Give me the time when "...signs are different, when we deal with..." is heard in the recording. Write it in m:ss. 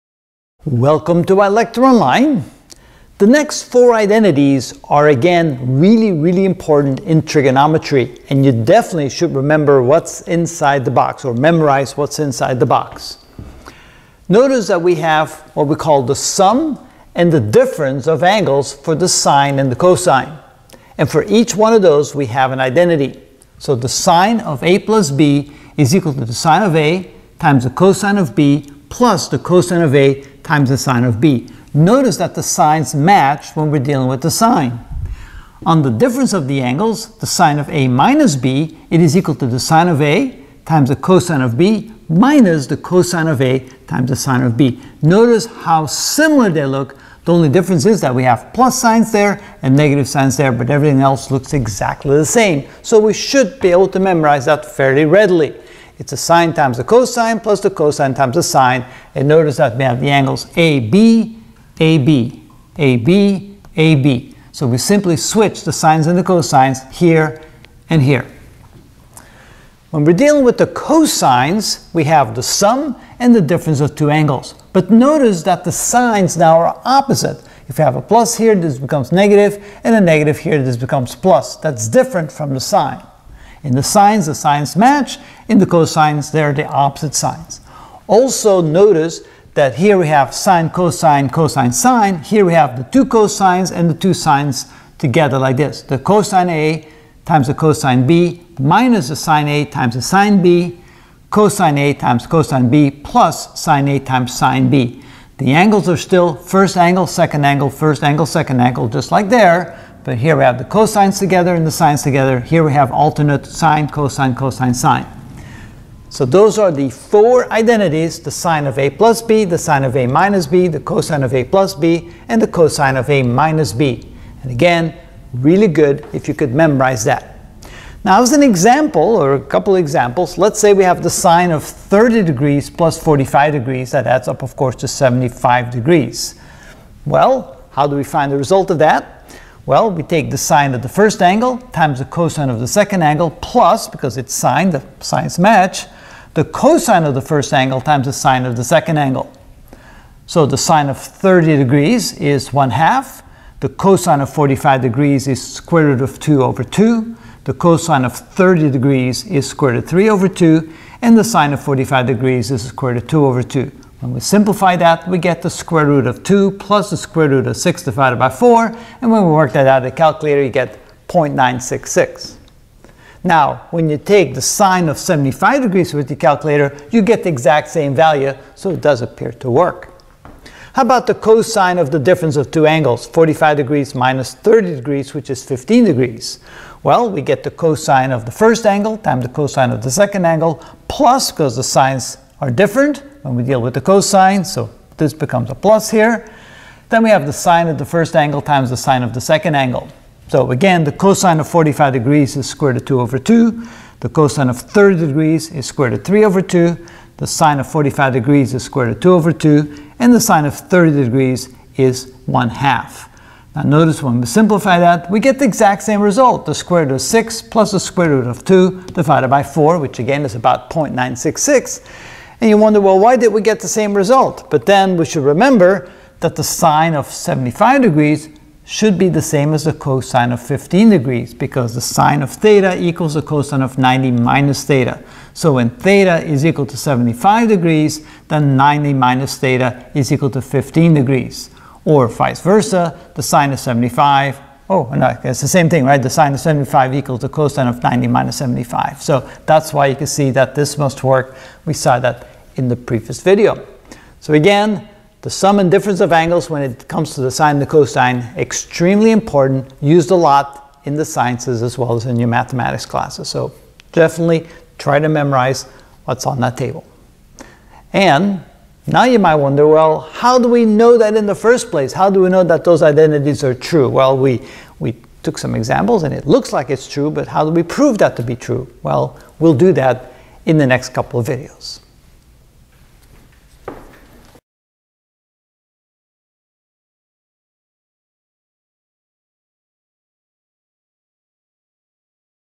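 3:11.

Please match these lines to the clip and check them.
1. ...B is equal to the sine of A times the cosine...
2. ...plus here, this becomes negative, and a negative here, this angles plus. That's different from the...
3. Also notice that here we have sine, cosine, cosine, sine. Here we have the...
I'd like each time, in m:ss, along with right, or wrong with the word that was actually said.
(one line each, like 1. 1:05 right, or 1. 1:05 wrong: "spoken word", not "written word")
1. 0:25 right
2. 1:18 wrong: "becomes", not "angles"
3. 1:28 right.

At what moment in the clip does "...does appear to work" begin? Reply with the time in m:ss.
2:58.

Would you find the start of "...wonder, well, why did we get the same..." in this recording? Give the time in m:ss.
3:42.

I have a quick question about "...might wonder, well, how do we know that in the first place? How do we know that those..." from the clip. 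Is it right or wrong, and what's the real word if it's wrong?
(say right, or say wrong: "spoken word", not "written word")
right.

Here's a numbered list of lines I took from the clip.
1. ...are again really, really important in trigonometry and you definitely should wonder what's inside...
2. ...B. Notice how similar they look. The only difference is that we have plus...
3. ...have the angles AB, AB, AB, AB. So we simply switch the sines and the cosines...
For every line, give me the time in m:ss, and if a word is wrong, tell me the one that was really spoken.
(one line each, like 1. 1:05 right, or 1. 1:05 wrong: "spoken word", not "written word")
1. 0:04 wrong: "remember", not "wonder"
2. 0:44 right
3. 0:59 right.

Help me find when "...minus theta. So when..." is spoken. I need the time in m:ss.
3:54.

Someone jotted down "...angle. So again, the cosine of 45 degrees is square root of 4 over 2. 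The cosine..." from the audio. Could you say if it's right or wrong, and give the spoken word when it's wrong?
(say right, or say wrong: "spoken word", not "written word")
wrong: "2", not "4".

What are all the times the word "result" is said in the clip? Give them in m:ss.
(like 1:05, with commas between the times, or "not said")
2:18, 3:36, 3:43.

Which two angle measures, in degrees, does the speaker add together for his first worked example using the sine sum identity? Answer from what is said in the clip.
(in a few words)
30 and 45 degrees.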